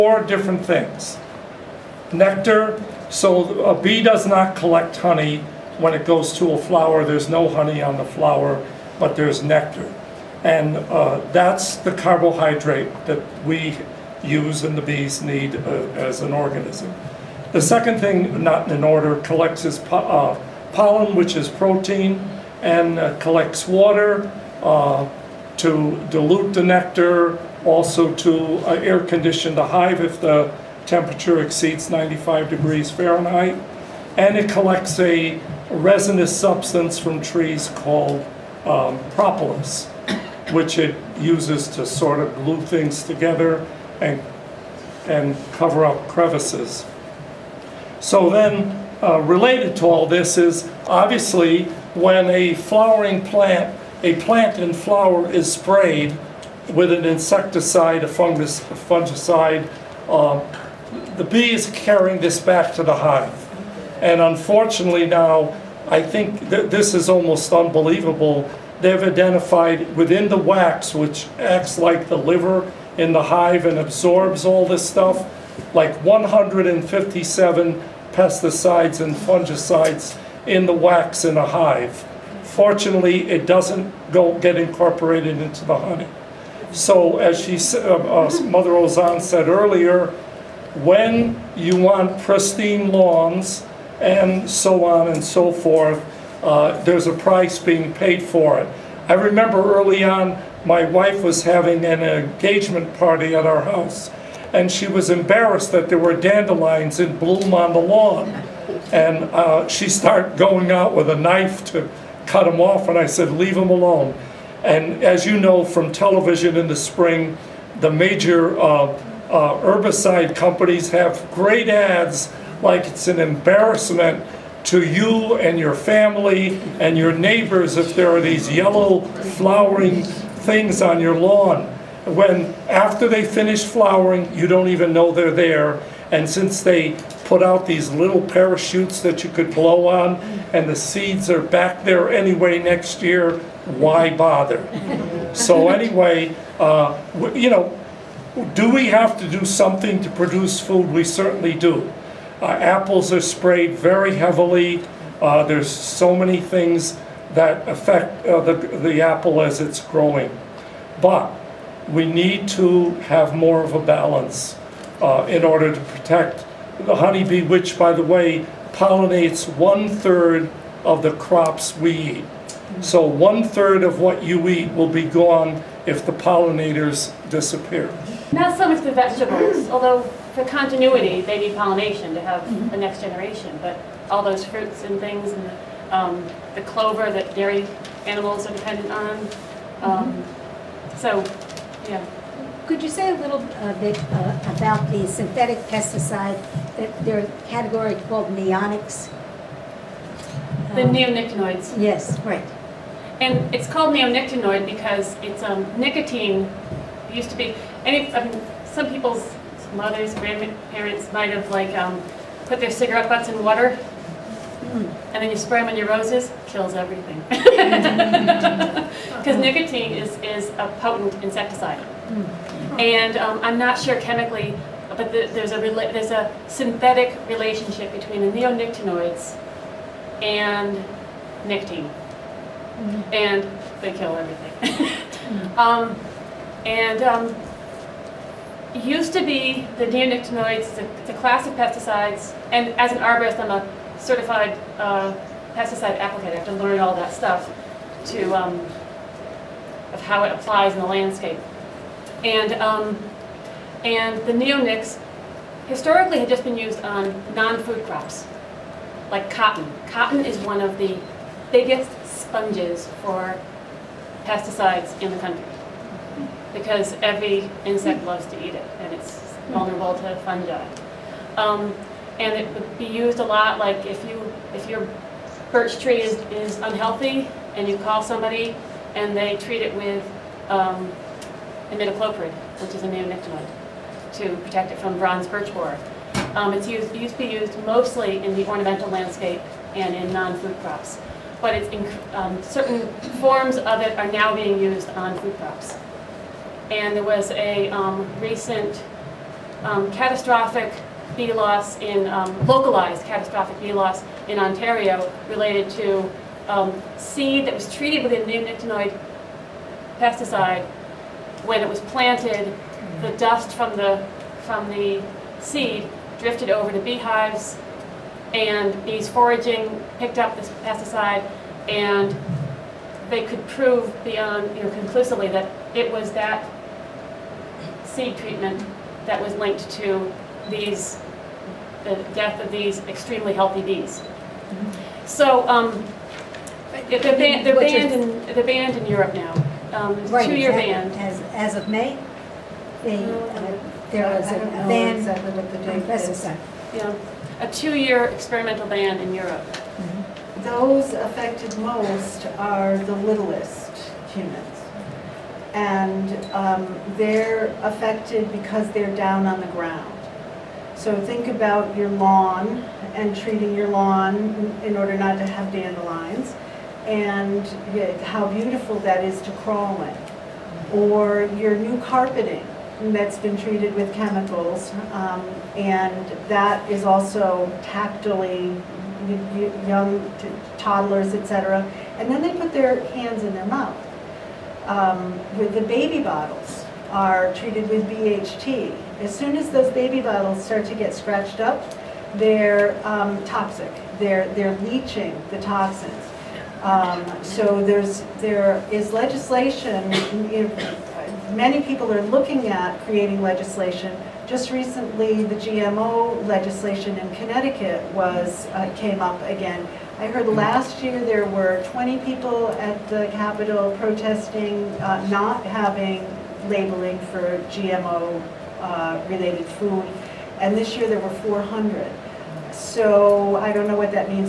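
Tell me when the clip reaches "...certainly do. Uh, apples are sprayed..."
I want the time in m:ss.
2:31.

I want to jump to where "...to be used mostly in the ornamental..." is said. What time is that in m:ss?
4:47.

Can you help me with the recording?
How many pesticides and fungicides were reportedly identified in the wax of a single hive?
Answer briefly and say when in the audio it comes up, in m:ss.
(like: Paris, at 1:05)
157, at 1:16.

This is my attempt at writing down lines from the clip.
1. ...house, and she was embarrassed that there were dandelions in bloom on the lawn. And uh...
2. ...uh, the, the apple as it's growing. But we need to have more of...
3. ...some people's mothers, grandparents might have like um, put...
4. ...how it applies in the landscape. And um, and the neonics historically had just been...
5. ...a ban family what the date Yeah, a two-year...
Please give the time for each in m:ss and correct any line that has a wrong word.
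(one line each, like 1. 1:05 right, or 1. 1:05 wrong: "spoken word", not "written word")
1. 1:43 right
2. 2:38 right
3. 3:28 right
4. 4:10 right
5. 5:44 wrong: "exactly", not "family".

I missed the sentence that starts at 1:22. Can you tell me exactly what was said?
Fortunately, it doesn't go get incorporated into the honey.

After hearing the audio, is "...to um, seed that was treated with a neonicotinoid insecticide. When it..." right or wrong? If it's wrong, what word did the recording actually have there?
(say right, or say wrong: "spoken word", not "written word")
wrong: "pesticide", not "insecticide".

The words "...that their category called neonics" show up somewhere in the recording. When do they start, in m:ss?
3:16.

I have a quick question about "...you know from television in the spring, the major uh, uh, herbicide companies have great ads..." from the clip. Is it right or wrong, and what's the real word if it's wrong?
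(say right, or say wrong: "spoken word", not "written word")
right.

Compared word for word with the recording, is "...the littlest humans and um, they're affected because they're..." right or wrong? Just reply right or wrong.
right.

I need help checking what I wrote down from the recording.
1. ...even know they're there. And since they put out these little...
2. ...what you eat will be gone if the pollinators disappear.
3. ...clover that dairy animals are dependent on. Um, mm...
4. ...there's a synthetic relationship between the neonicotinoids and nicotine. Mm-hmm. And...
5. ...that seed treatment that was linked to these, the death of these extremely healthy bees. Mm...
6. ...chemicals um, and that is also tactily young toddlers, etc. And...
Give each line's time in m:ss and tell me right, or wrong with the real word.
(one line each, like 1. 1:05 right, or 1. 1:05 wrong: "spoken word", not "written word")
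1. 2:14 right
2. 2:53 right
3. 3:06 right
4. 3:45 right
5. 5:26 right
6. 6:13 right.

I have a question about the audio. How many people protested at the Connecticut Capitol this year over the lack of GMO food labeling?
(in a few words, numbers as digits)
400.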